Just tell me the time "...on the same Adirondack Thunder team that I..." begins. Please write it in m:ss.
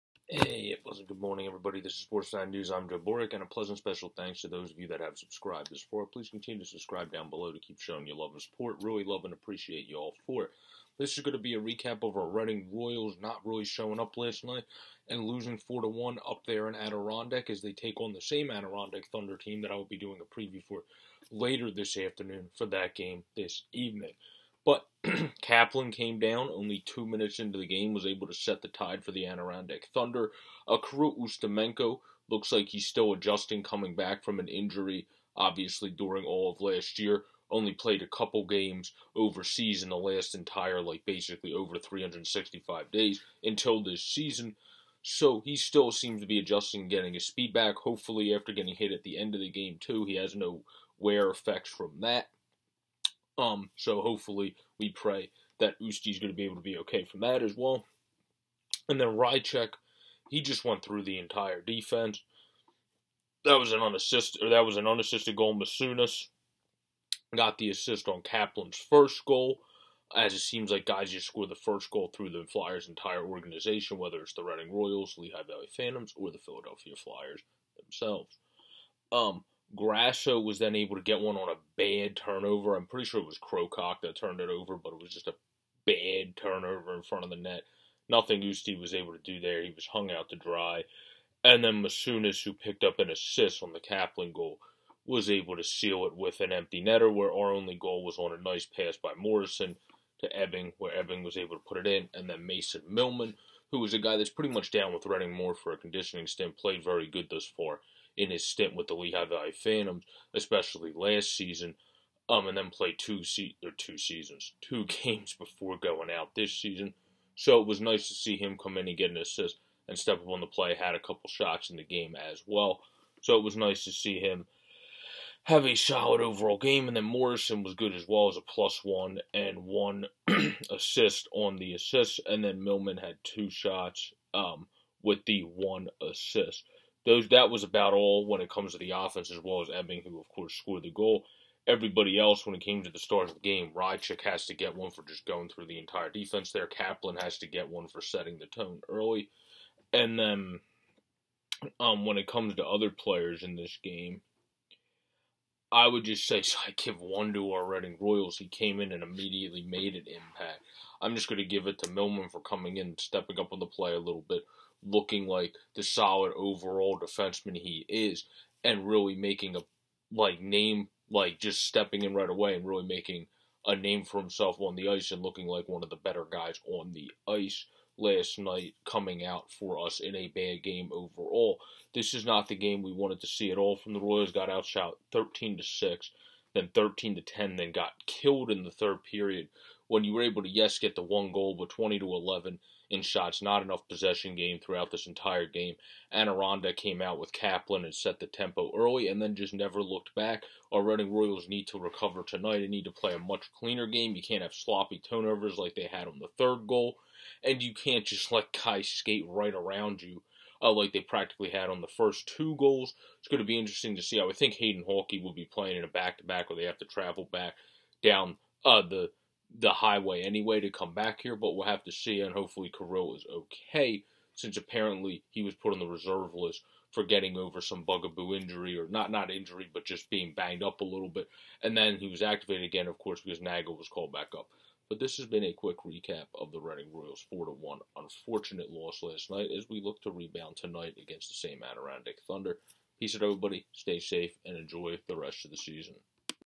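0:17.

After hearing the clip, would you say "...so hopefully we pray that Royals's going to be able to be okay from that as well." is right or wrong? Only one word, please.
wrong.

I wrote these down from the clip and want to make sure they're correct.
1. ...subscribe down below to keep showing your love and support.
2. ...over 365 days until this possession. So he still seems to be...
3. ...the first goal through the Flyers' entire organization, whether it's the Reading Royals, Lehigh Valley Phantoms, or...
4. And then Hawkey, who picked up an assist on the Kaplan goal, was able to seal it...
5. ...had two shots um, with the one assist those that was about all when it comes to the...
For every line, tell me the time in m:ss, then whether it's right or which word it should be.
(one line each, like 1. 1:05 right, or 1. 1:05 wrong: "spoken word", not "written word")
1. 0:06 right
2. 0:41 wrong: "season", not "possession"
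3. 1:11 right
4. 1:31 wrong: "Masunas", not "Hawkey"
5. 2:12 right.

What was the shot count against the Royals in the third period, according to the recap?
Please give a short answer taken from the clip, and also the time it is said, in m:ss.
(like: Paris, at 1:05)
20 to 11, at 3:11.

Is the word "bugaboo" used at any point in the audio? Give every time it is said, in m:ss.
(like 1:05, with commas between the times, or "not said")
3:47.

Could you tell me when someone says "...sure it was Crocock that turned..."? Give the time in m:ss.
1:23.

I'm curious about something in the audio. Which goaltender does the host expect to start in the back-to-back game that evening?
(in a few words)
Hayden Hawkey.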